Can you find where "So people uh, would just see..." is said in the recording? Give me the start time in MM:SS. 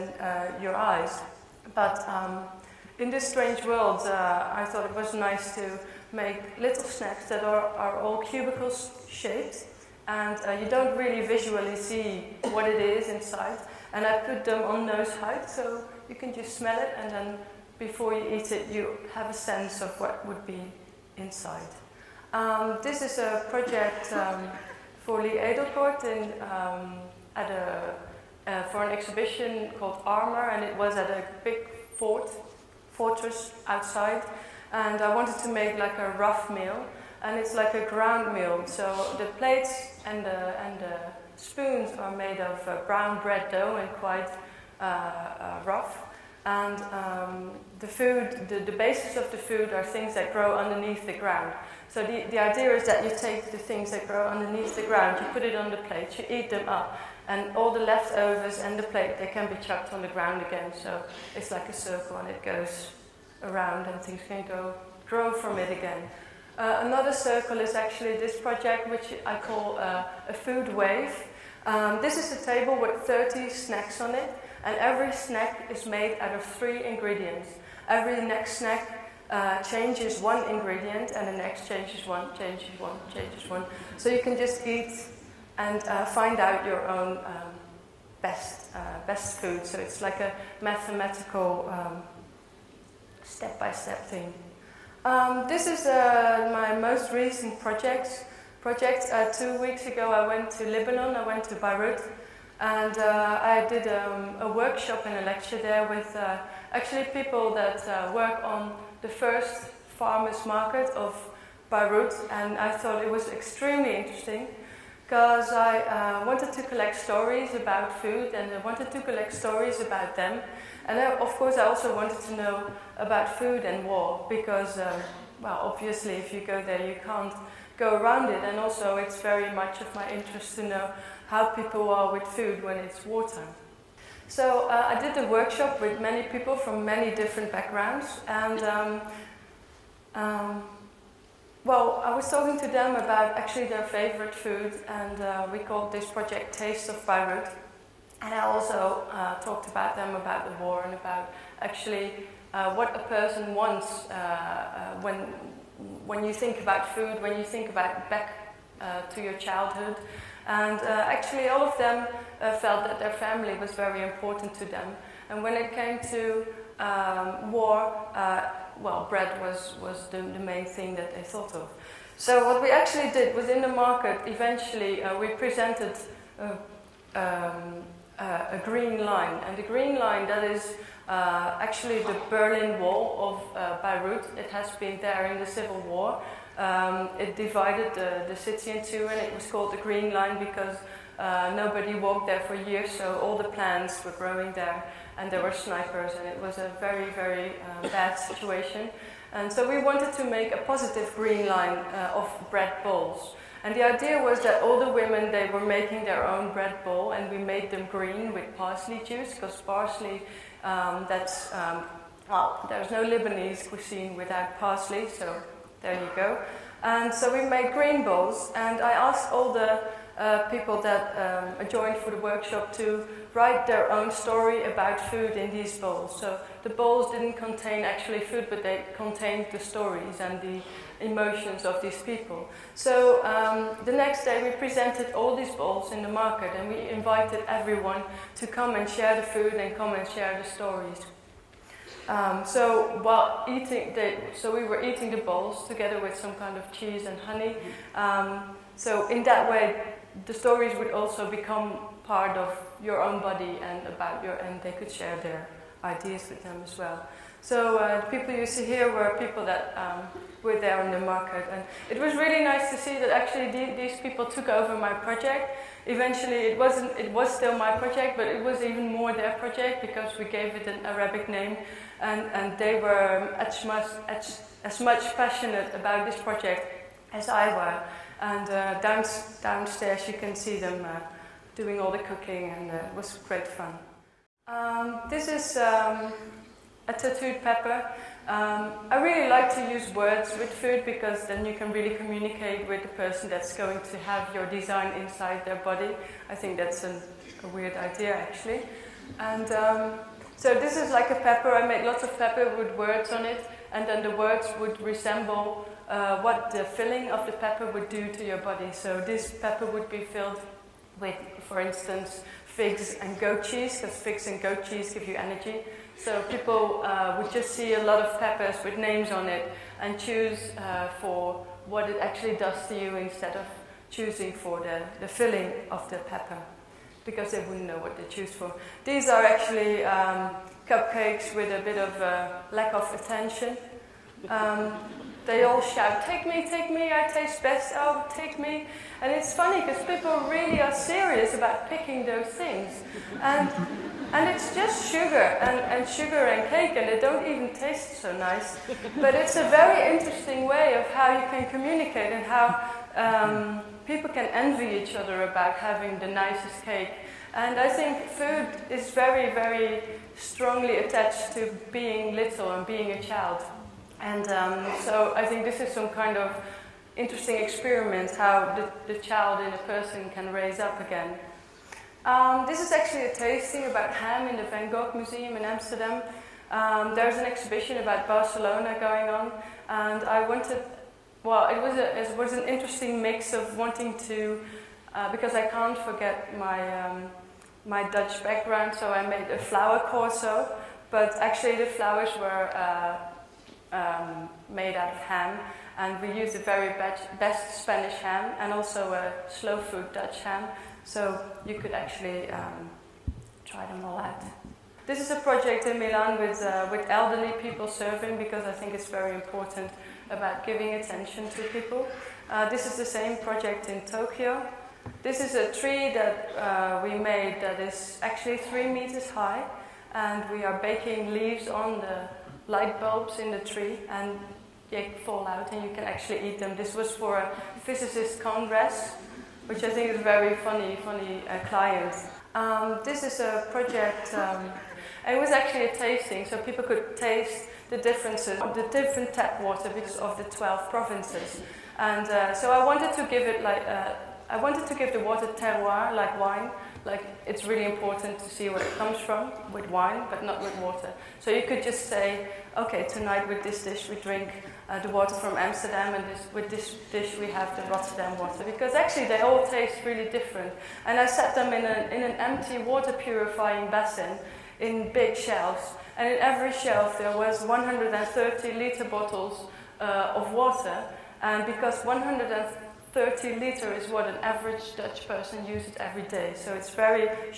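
05:15.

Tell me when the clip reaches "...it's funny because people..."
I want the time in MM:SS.
05:39.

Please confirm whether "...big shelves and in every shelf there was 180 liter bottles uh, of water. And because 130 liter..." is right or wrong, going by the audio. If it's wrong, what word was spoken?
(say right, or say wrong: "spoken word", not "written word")
wrong: "130", not "180".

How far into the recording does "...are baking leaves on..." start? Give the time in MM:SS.
07:00.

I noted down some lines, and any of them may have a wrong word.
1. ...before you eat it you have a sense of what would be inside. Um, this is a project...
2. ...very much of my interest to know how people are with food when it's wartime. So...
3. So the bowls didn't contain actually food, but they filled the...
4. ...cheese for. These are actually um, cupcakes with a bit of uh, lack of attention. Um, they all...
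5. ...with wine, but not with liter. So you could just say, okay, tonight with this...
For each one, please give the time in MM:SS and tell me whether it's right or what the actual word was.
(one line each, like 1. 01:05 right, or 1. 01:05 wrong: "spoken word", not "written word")
1. 00:17 right
2. 02:09 right
3. 03:46 wrong: "contained", not "filled"
4. 05:28 wrong: "choose", not "cheese"
5. 07:29 wrong: "water", not "liter".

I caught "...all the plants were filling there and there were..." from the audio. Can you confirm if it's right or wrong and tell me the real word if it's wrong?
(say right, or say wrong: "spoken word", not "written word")
wrong: "growing", not "filling".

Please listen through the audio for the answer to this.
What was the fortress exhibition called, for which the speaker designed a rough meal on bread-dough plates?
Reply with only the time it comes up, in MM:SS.
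00:30.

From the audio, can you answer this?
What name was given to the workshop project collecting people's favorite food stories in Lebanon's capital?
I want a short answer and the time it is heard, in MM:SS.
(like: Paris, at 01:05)
Taste of Beirut, at 02:26.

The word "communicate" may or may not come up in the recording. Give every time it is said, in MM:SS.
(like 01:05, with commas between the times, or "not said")
04:51, 05:51.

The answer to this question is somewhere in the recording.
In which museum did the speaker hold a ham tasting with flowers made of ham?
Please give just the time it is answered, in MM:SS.
06:14.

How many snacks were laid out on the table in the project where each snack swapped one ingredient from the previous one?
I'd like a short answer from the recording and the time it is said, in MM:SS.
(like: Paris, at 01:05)
30, at 01:13.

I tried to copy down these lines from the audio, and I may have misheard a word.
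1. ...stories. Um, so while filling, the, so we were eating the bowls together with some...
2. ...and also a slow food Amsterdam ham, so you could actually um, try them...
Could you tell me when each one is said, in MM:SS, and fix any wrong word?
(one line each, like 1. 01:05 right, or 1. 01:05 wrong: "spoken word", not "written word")
1. 04:00 wrong: "eating", not "filling"
2. 06:38 wrong: "Dutch", not "Amsterdam".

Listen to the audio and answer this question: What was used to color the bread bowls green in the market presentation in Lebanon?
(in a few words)
parsley juice.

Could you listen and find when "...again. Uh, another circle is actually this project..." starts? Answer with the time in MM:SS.
01:05.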